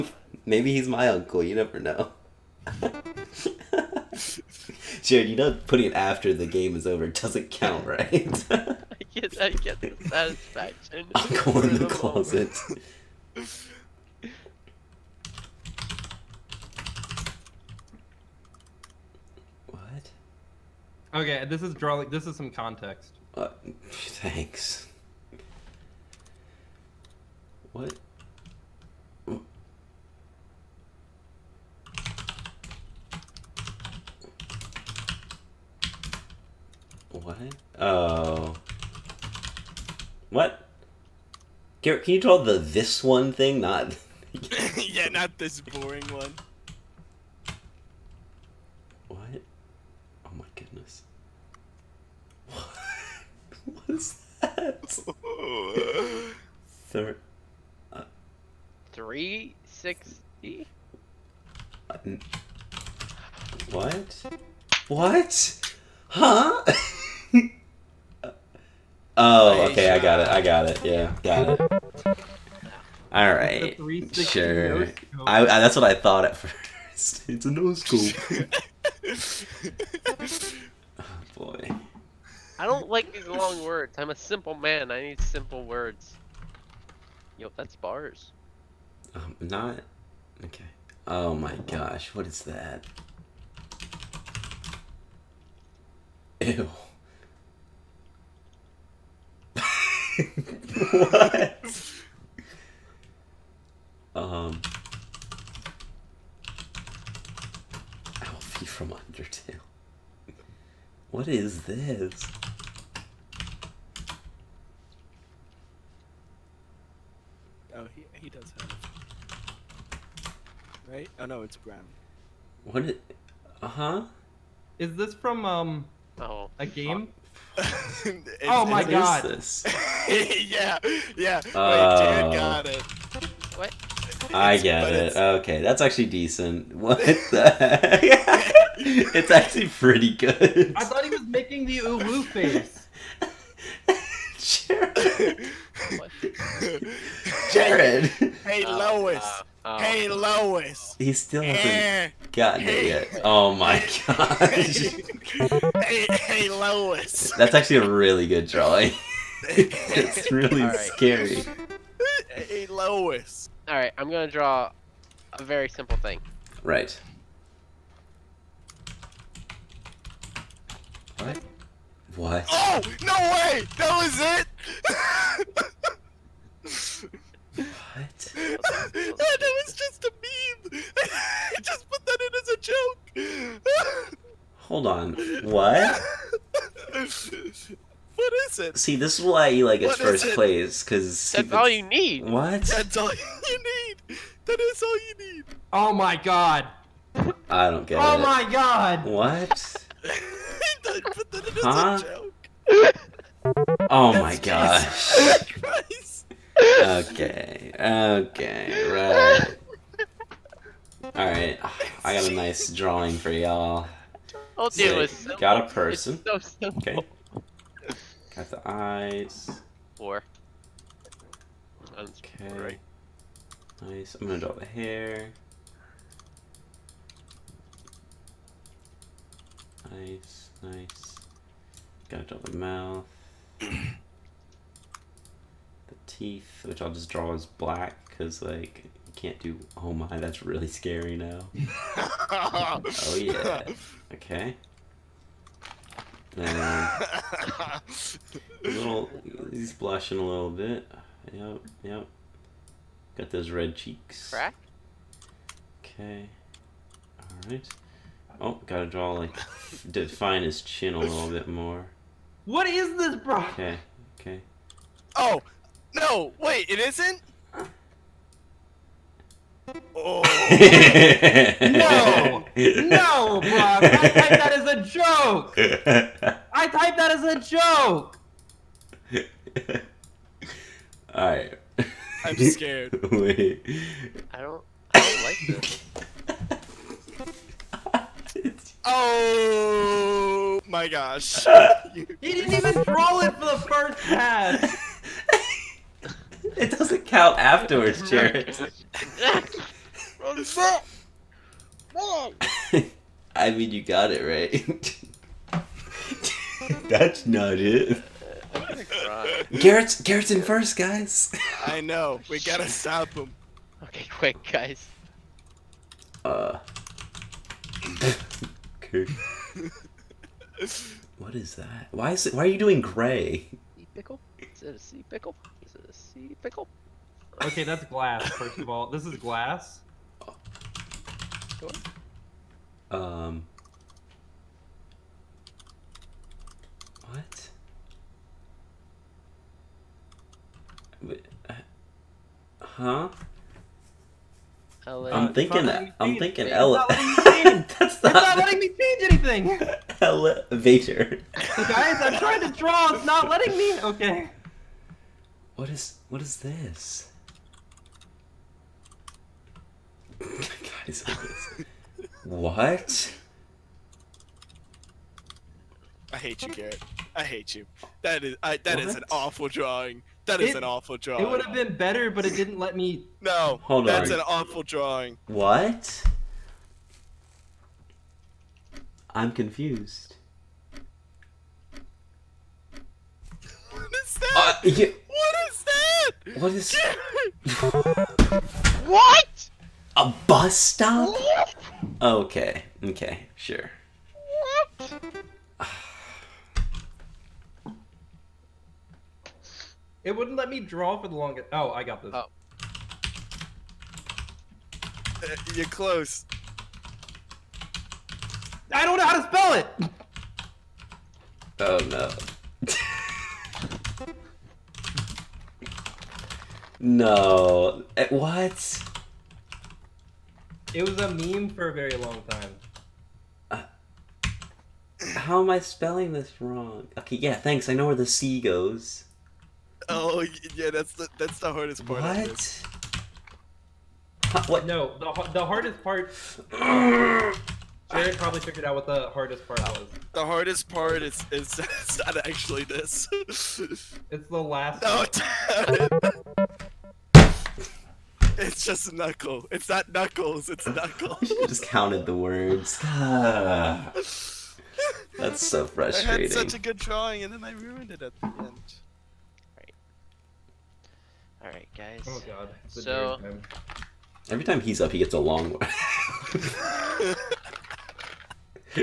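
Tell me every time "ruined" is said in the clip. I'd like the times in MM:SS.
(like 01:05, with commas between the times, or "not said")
07:37.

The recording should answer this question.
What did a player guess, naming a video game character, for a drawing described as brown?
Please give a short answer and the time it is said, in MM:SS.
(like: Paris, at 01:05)
Alfie from Undertale, at 01:48.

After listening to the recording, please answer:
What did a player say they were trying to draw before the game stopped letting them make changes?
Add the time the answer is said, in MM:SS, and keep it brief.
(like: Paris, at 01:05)
Elevator, at 05:50.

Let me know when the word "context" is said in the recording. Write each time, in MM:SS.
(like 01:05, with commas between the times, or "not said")
00:22.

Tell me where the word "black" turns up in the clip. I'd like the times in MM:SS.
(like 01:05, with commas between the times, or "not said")
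03:57.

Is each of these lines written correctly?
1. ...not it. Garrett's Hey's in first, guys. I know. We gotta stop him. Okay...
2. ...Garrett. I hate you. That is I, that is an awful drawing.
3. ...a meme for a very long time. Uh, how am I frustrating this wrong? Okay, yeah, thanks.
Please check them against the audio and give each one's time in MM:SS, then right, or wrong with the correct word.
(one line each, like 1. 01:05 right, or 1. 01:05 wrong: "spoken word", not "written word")
1. 05:07 wrong: "Garrett", not "Hey"
2. 06:06 right
3. 07:00 wrong: "spelling", not "frustrating".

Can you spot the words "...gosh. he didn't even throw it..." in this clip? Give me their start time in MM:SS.
04:50.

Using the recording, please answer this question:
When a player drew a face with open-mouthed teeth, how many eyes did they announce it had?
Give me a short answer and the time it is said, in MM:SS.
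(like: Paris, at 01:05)
Four, at 03:39.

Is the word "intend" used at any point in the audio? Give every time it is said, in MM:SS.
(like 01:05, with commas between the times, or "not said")
not said.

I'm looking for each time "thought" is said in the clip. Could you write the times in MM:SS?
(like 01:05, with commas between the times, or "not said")
01:15, 02:20.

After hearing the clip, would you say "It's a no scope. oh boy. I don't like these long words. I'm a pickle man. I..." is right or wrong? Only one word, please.
wrong.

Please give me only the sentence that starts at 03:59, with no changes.
Oh my, that's really scary now.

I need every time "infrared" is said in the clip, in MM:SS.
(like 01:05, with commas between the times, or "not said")
not said.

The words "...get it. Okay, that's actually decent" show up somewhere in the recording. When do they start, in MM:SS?
02:14.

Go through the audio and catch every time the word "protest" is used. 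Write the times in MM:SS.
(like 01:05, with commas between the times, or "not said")
not said.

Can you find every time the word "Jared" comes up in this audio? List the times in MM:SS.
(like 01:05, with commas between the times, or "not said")
00:05, 02:27, 04:58, 07:17.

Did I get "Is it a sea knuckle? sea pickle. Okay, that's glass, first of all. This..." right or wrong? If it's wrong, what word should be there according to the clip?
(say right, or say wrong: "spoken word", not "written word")
wrong: "pickle", not "knuckle".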